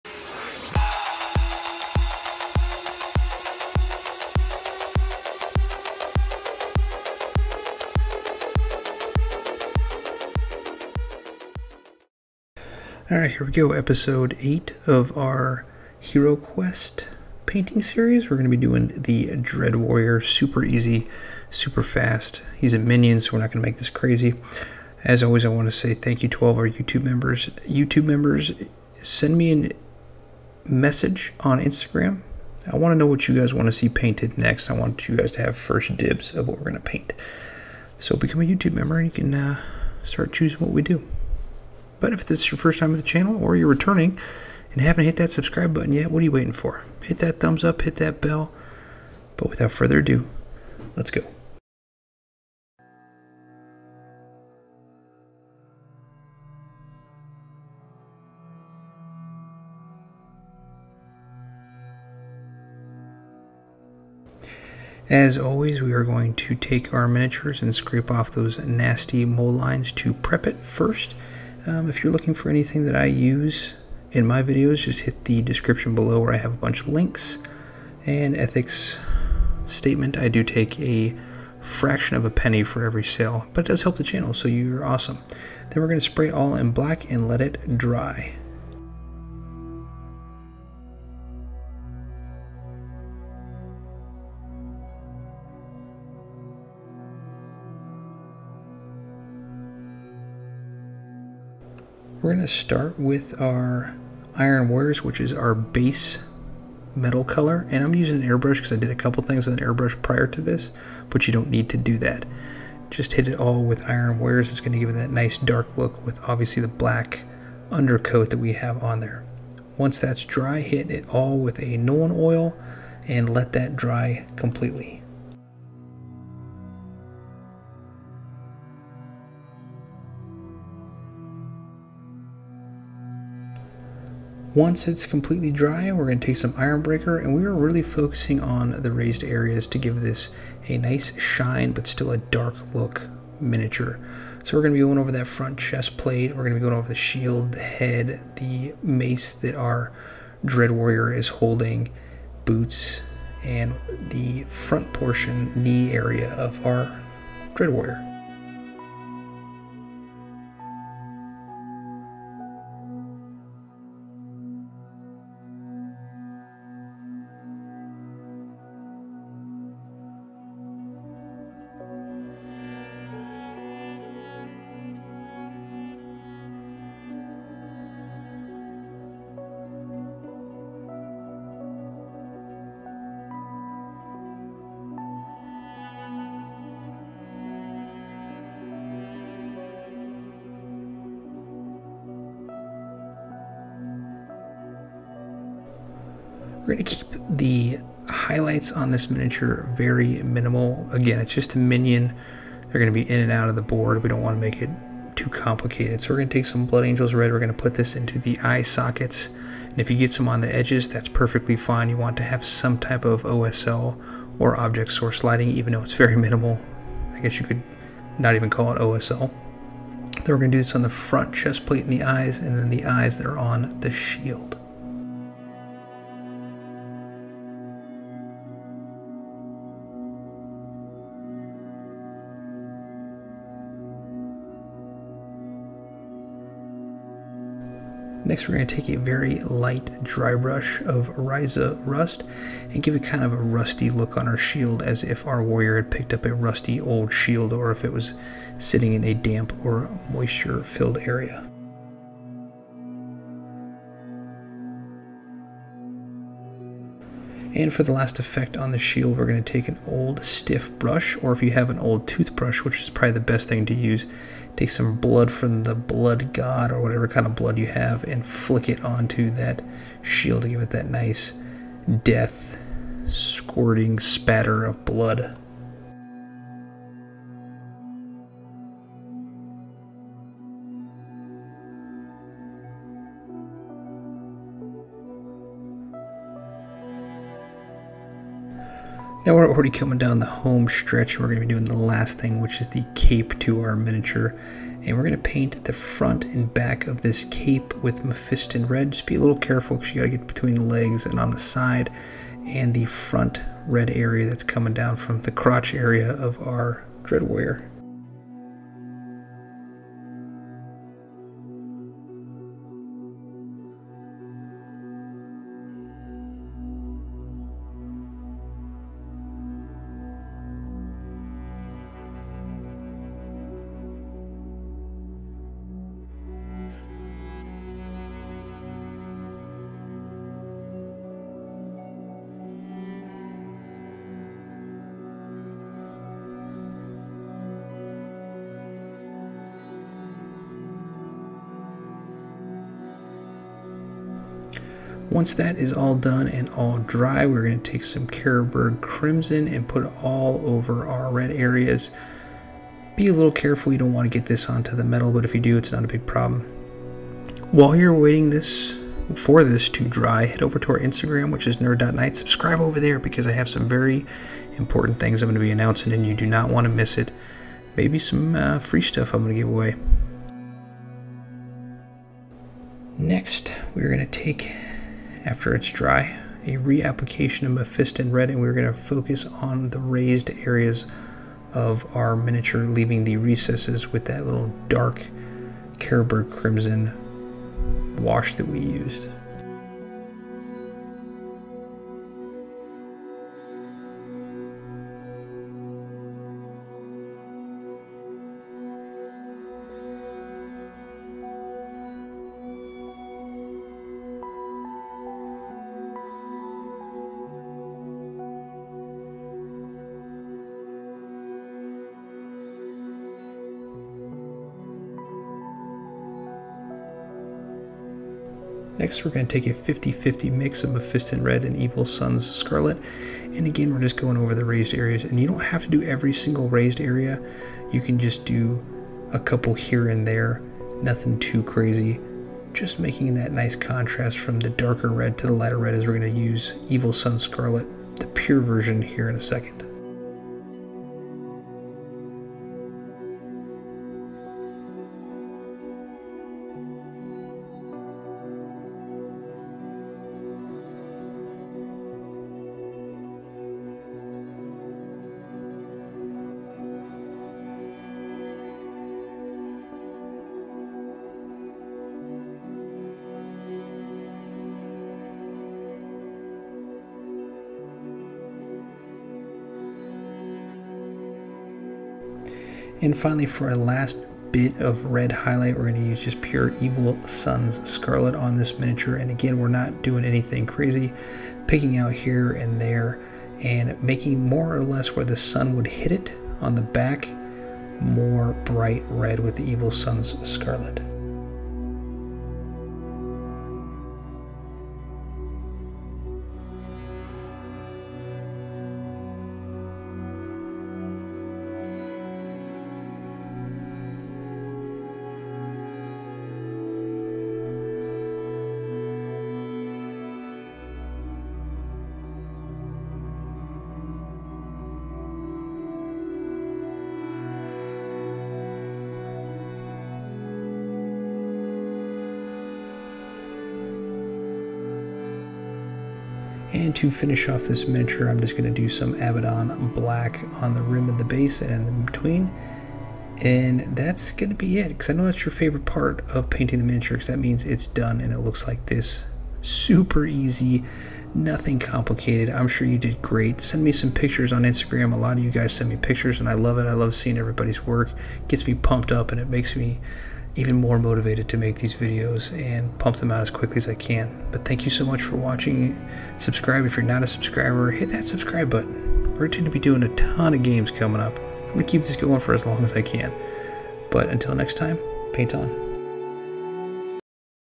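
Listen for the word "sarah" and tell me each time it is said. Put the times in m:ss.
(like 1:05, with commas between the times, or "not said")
not said.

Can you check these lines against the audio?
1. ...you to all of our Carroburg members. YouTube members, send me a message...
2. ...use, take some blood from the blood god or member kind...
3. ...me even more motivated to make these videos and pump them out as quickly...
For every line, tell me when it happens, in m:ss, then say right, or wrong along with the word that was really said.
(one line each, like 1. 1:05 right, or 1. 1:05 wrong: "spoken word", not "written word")
1. 0:26 wrong: "YouTube", not "Carroburg"
2. 4:23 wrong: "whatever", not "member"
3. 9:09 right.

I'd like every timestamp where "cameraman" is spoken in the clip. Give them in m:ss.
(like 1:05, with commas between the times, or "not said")
not said.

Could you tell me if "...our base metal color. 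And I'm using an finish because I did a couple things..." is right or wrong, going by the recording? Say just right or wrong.
wrong.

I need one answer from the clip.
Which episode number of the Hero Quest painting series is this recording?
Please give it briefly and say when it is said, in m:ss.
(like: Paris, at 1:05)
8, at 0:13.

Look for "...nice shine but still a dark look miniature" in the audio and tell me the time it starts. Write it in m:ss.
2:20.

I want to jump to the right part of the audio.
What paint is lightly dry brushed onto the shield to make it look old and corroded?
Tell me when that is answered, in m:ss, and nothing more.
4:01.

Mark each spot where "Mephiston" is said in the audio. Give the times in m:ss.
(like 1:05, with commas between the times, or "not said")
4:58, 6:17, 7:00.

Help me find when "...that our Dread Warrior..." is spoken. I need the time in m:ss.
2:29.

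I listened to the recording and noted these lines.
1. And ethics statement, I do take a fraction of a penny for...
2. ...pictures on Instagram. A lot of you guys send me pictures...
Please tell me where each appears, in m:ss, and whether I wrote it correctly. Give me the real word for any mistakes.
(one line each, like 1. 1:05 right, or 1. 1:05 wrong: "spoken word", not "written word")
1. 1:18 right
2. 9:03 right.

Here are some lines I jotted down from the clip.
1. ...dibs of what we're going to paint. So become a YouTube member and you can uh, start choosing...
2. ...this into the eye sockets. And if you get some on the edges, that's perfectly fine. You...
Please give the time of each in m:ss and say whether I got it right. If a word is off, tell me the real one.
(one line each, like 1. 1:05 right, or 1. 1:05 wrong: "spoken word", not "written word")
1. 0:35 right
2. 3:27 right.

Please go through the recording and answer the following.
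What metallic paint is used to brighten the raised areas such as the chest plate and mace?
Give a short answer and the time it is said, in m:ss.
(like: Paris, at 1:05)
Ironbreaker, at 2:16.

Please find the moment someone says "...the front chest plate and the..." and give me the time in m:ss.
3:40.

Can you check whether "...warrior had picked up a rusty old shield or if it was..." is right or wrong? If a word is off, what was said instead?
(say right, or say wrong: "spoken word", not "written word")
right.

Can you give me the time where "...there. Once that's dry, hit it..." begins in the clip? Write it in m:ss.
1:58.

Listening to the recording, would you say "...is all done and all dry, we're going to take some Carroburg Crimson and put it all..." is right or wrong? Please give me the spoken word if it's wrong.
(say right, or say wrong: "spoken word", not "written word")
right.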